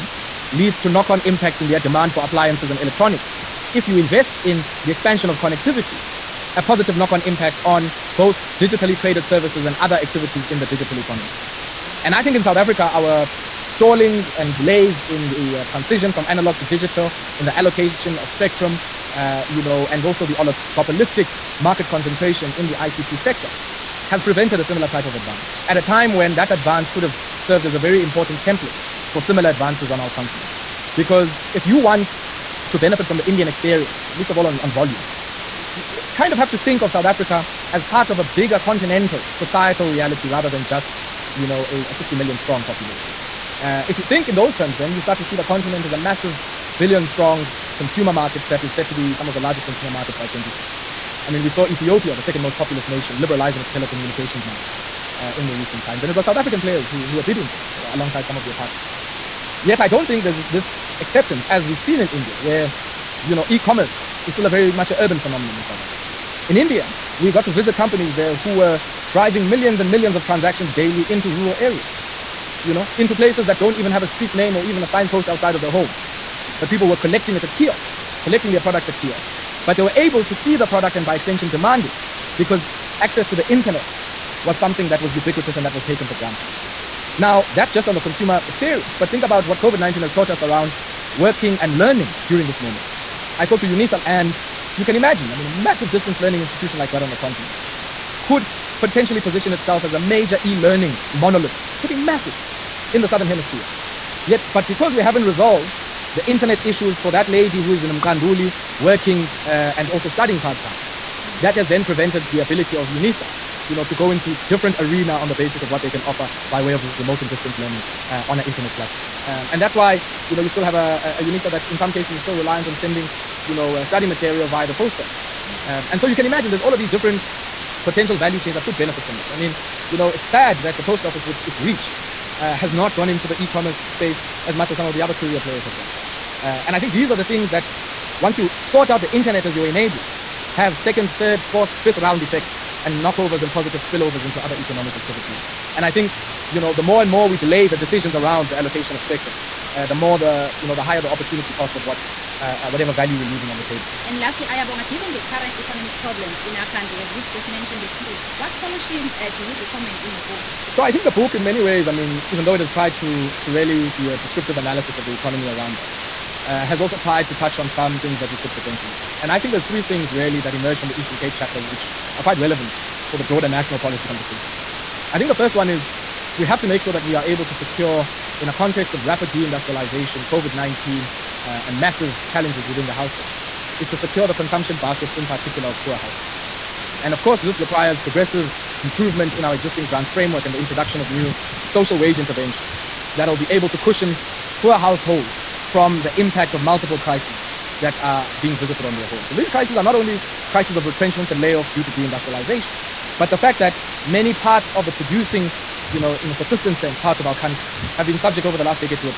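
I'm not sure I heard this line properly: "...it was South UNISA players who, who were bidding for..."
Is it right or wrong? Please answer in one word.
wrong.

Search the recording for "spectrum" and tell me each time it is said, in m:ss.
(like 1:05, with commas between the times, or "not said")
0:18, 2:29.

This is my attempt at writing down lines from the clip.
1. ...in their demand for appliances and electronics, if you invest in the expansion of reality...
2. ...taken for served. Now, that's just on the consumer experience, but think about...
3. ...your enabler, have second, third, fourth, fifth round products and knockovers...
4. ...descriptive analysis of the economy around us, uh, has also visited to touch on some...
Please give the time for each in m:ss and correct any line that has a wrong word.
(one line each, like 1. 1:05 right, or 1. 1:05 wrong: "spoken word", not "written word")
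1. 0:01 wrong: "connectivity", not "reality"
2. 1:25 wrong: "granted", not "served"
3. 2:19 wrong: "effects", not "products"
4. 2:44 wrong: "tried", not "visited".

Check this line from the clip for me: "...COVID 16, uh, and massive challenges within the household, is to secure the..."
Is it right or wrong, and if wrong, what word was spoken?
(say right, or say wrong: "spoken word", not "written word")
wrong: "19", not "16".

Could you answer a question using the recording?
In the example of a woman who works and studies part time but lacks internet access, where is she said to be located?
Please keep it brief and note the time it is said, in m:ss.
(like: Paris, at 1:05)
Mqanduli, at 1:47.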